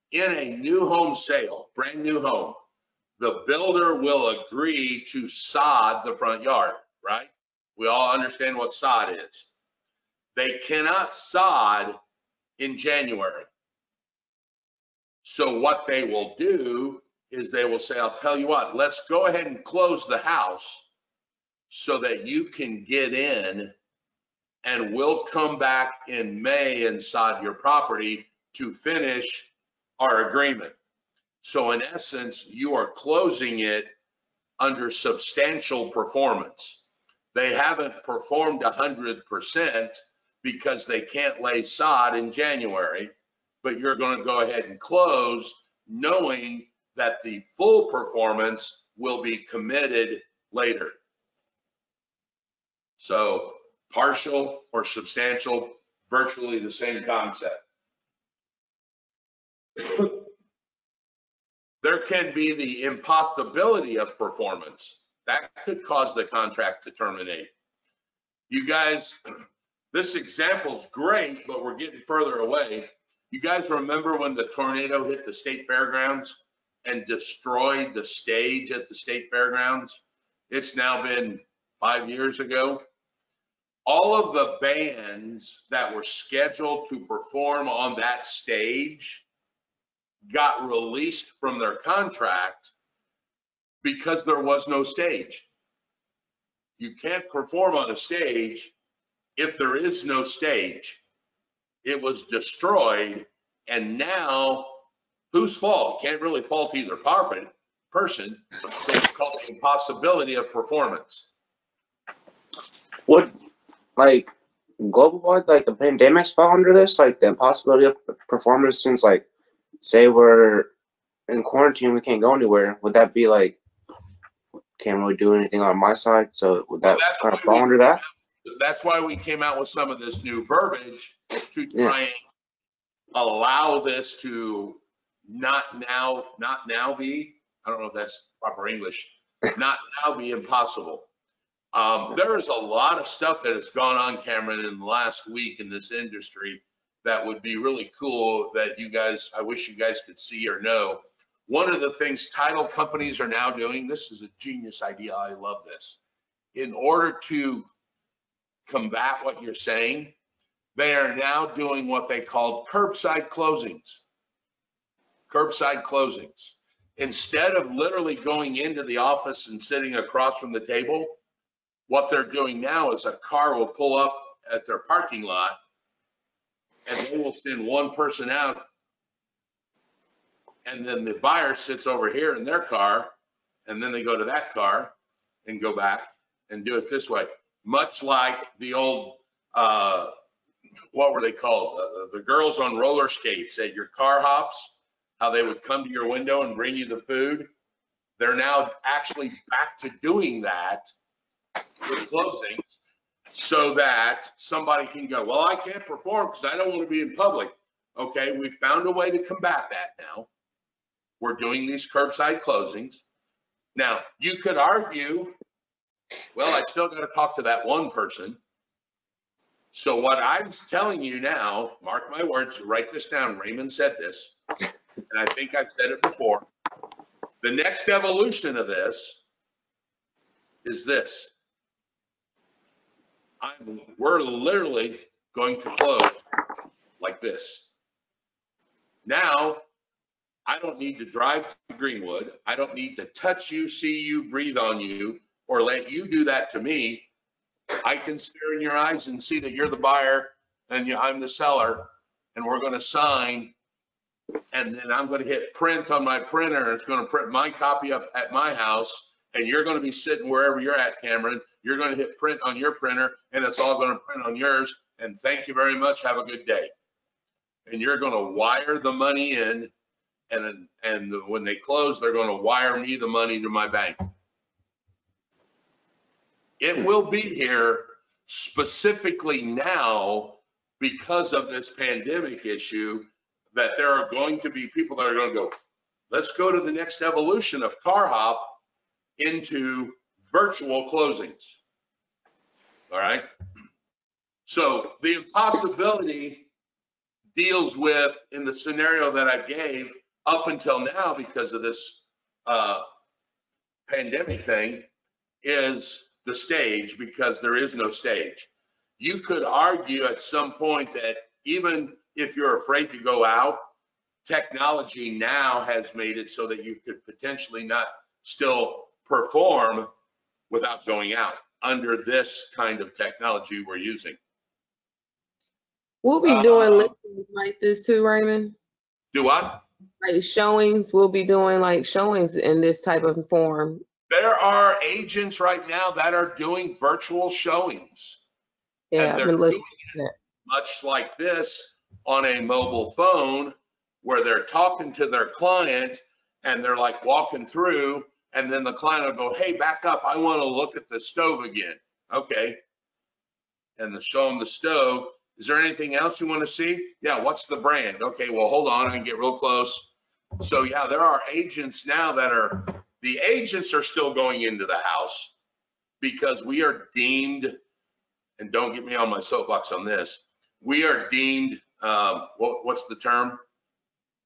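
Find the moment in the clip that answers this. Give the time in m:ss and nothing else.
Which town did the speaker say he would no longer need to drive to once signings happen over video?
4:01.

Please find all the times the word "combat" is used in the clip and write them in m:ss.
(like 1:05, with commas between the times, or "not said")
2:38, 3:29.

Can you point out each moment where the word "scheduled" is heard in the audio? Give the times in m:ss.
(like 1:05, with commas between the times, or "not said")
1:26.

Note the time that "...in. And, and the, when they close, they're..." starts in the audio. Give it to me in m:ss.
4:29.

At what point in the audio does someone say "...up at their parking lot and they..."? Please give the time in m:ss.
2:53.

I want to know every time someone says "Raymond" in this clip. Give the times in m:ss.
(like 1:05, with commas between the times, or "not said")
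3:43, 5:28.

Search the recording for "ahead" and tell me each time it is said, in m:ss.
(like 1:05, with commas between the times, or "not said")
0:19, 0:44.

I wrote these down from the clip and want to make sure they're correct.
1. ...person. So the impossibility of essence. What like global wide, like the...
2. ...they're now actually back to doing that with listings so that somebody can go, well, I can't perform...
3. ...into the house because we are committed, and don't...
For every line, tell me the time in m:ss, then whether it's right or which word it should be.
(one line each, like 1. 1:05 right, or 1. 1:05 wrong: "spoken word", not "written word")
1. 1:47 wrong: "performance", not "essence"
2. 3:18 wrong: "closings", not "listings"
3. 6:04 wrong: "deemed", not "committed".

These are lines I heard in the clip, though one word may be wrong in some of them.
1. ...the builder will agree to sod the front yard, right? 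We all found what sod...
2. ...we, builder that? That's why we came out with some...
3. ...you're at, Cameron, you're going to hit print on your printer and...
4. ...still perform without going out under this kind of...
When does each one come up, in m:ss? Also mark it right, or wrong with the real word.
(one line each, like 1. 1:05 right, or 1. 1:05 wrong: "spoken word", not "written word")
1. 0:03 wrong: "understand", not "found"
2. 2:07 wrong: "under", not "builder"
3. 4:20 right
4. 5:18 right.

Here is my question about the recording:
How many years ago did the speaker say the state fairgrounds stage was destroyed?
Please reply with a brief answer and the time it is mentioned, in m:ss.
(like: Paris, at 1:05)
5, at 1:21.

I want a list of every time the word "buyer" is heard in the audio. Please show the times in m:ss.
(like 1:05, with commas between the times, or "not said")
3:01, 4:09.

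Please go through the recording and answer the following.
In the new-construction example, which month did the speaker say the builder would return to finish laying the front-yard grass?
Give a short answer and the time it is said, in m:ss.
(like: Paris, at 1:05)
May, at 0:26.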